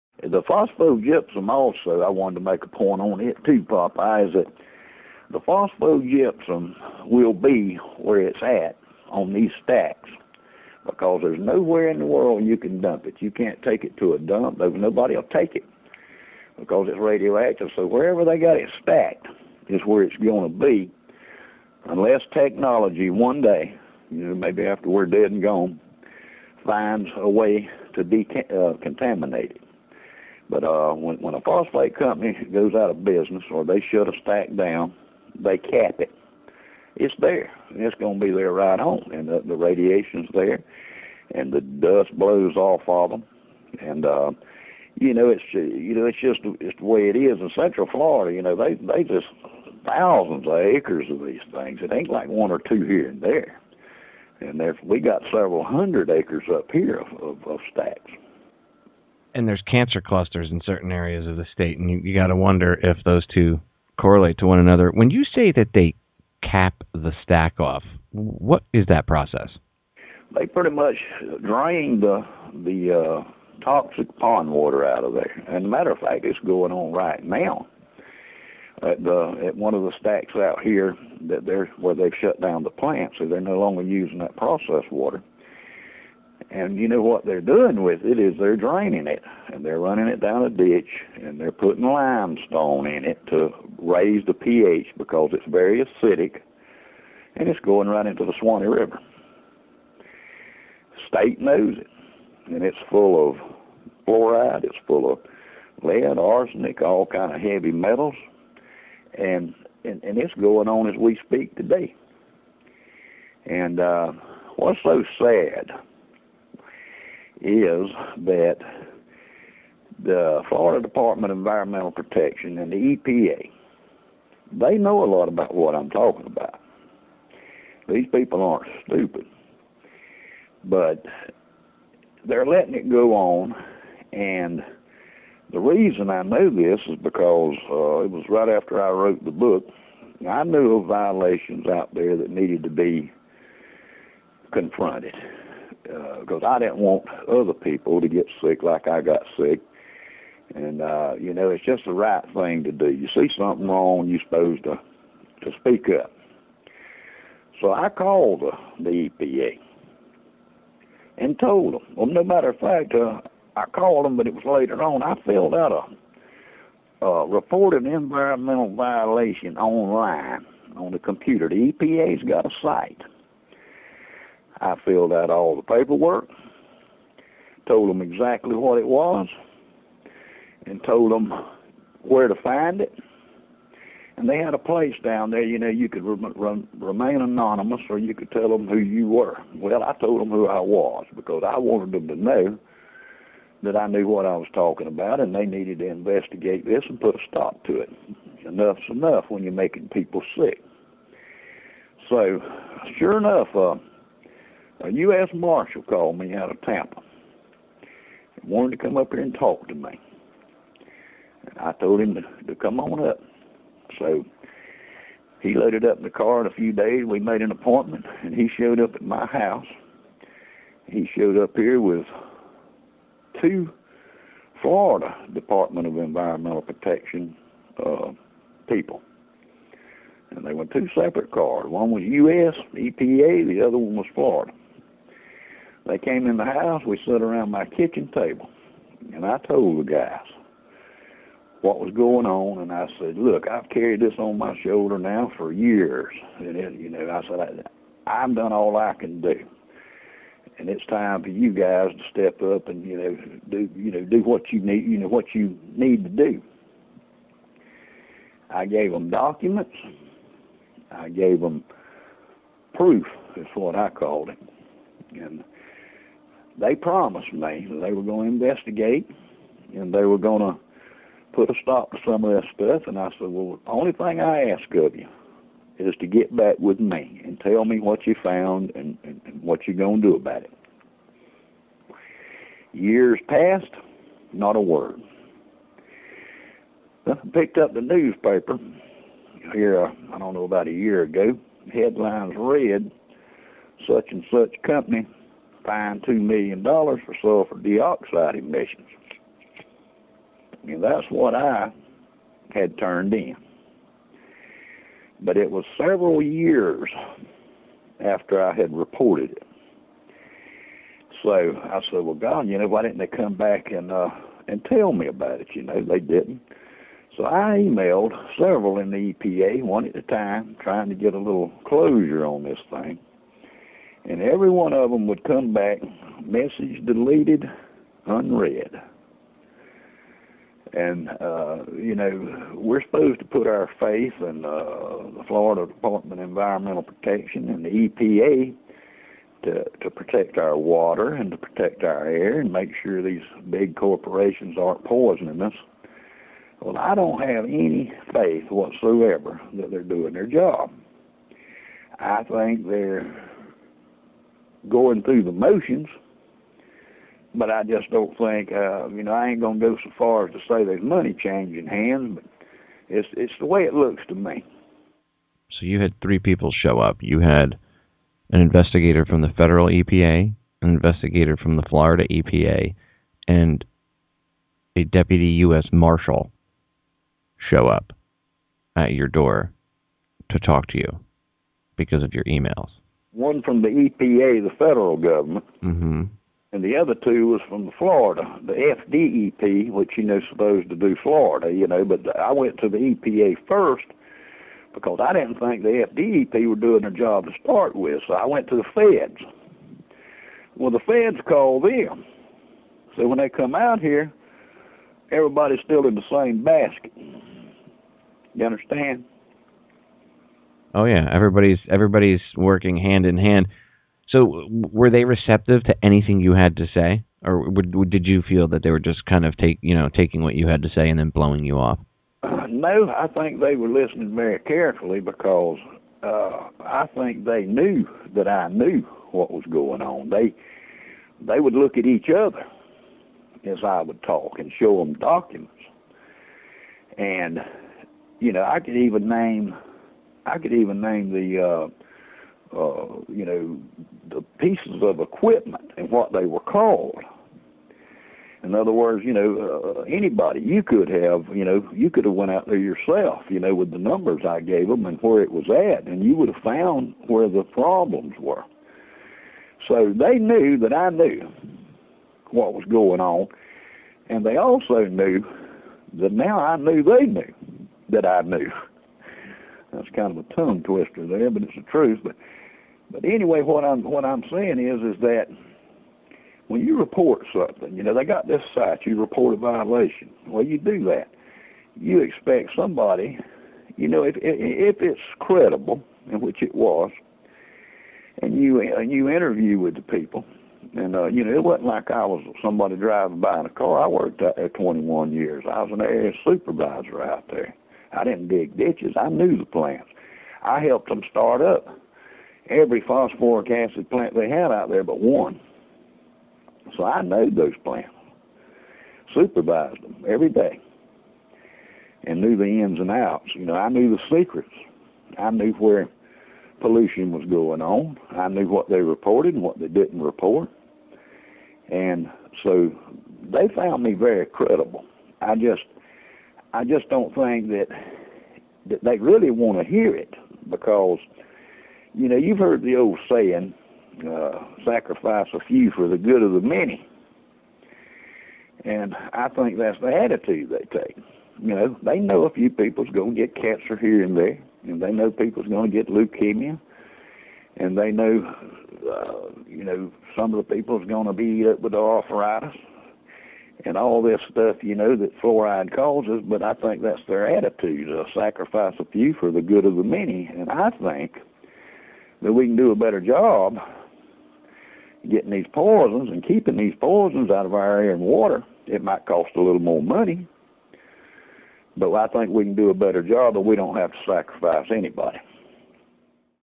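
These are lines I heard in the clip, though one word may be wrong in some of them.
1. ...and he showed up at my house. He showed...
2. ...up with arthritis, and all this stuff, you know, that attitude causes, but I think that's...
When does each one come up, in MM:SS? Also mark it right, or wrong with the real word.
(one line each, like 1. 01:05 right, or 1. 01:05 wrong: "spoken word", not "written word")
1. 03:38 right
2. 09:11 wrong: "fluoride", not "attitude".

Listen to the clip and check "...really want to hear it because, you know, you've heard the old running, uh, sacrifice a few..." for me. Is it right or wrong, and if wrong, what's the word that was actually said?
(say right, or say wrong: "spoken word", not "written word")
wrong: "saying", not "running".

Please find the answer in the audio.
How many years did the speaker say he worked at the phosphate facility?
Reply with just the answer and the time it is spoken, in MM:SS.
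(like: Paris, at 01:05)
21, at 08:14.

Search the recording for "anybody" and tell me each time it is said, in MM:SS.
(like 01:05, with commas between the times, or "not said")
07:29, 09:34.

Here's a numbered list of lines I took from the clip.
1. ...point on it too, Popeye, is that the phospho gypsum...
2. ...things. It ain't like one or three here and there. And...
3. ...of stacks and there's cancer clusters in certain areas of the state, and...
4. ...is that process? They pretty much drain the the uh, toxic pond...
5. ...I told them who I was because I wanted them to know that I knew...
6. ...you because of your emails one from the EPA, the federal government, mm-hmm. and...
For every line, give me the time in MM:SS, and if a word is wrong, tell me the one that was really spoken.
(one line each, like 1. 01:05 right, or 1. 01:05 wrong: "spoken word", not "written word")
1. 00:02 right
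2. 00:51 wrong: "two", not "three"
3. 00:57 right
4. 01:08 right
5. 03:09 right
6. 06:20 right.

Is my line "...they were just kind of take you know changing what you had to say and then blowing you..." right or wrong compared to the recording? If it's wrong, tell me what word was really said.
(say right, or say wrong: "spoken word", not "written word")
wrong: "taking", not "changing".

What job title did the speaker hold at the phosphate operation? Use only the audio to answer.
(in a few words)
area supervisor.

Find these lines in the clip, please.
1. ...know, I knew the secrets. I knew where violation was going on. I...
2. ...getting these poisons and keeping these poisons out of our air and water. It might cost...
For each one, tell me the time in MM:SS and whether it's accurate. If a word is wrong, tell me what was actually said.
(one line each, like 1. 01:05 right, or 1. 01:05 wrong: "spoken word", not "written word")
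1. 08:33 wrong: "pollution", not "violation"
2. 09:25 right.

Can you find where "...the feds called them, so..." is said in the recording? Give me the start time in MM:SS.
06:40.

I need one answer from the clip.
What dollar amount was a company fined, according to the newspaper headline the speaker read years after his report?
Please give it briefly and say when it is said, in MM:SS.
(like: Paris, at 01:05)
$2 million, at 04:56.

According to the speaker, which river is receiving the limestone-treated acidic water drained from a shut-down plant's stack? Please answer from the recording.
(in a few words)
Suwannee River.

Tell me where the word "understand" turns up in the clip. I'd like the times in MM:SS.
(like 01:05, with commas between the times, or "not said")
06:48.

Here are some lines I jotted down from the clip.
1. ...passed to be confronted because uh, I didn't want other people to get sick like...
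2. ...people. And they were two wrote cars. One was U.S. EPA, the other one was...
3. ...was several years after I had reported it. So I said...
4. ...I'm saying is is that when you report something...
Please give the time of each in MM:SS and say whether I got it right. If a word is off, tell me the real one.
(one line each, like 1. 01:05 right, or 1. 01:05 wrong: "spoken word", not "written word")
1. 02:22 wrong: "needed", not "passed"
2. 03:48 wrong: "separate", not "wrote"
3. 05:05 right
4. 07:54 right.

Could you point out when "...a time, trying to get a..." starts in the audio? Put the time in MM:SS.
05:19.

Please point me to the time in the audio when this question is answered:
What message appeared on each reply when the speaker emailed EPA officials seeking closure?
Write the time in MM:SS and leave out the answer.
05:26.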